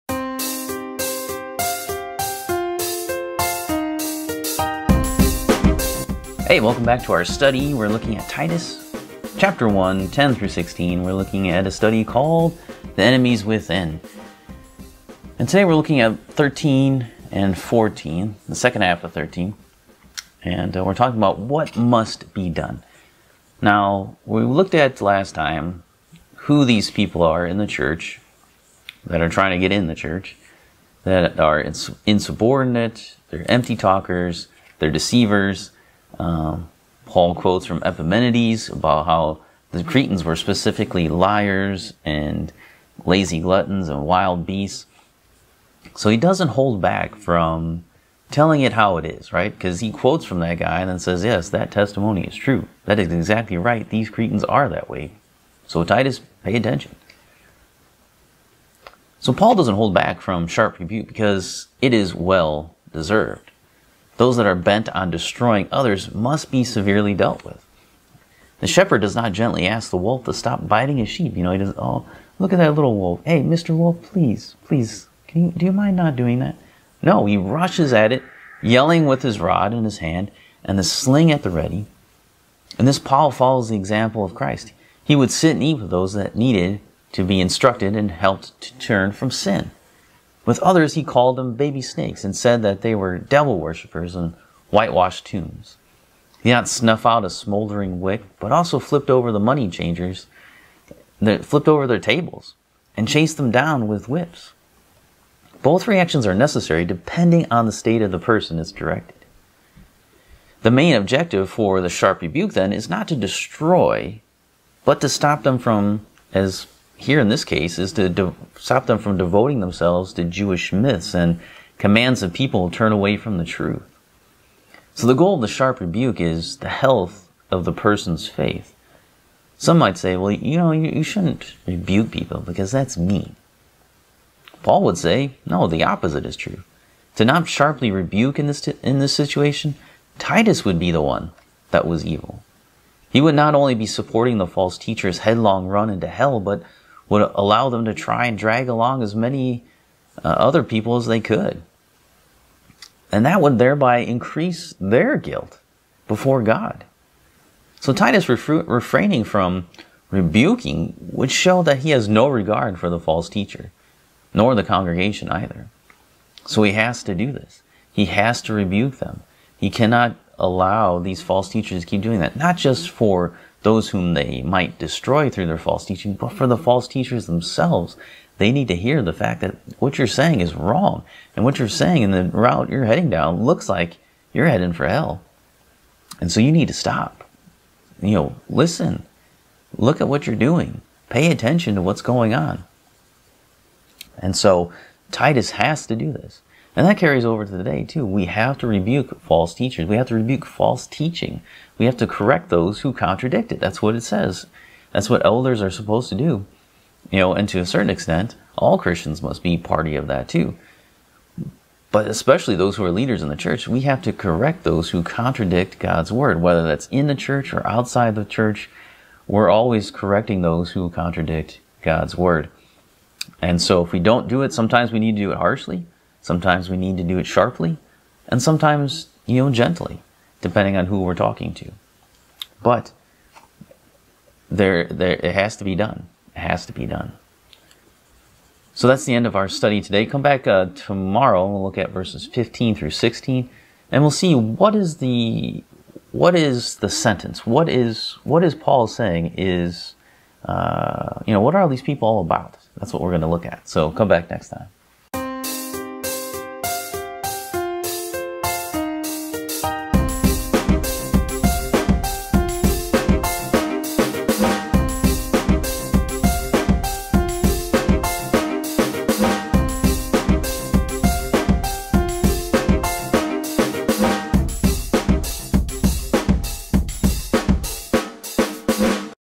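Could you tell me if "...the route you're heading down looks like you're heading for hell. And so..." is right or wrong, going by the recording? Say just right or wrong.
right.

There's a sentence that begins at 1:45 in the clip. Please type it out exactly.
Both reactions are necessary depending on the state of the person it's directed.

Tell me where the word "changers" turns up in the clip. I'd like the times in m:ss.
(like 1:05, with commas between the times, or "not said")
1:39.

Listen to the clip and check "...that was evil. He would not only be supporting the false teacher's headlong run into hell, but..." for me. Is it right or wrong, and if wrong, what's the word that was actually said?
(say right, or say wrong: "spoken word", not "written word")
right.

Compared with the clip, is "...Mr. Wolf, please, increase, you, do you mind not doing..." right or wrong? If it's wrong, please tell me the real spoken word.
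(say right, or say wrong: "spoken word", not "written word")
wrong: "please", not "increase".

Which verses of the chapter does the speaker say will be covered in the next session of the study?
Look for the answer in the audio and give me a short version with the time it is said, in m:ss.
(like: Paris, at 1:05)
15 through 16, at 4:02.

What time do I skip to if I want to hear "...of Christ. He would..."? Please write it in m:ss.
1:24.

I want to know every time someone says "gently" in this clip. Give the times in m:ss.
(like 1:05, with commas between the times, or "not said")
1:09, 3:49.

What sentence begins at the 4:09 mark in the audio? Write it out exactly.
Is uh, you know what are these people all about?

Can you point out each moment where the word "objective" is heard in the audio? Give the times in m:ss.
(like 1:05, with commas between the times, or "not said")
1:50.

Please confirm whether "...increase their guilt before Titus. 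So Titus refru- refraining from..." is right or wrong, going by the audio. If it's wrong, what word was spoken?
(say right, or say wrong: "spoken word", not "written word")
wrong: "God", not "Titus".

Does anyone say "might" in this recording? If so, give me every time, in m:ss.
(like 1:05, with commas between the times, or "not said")
2:09, 2:54.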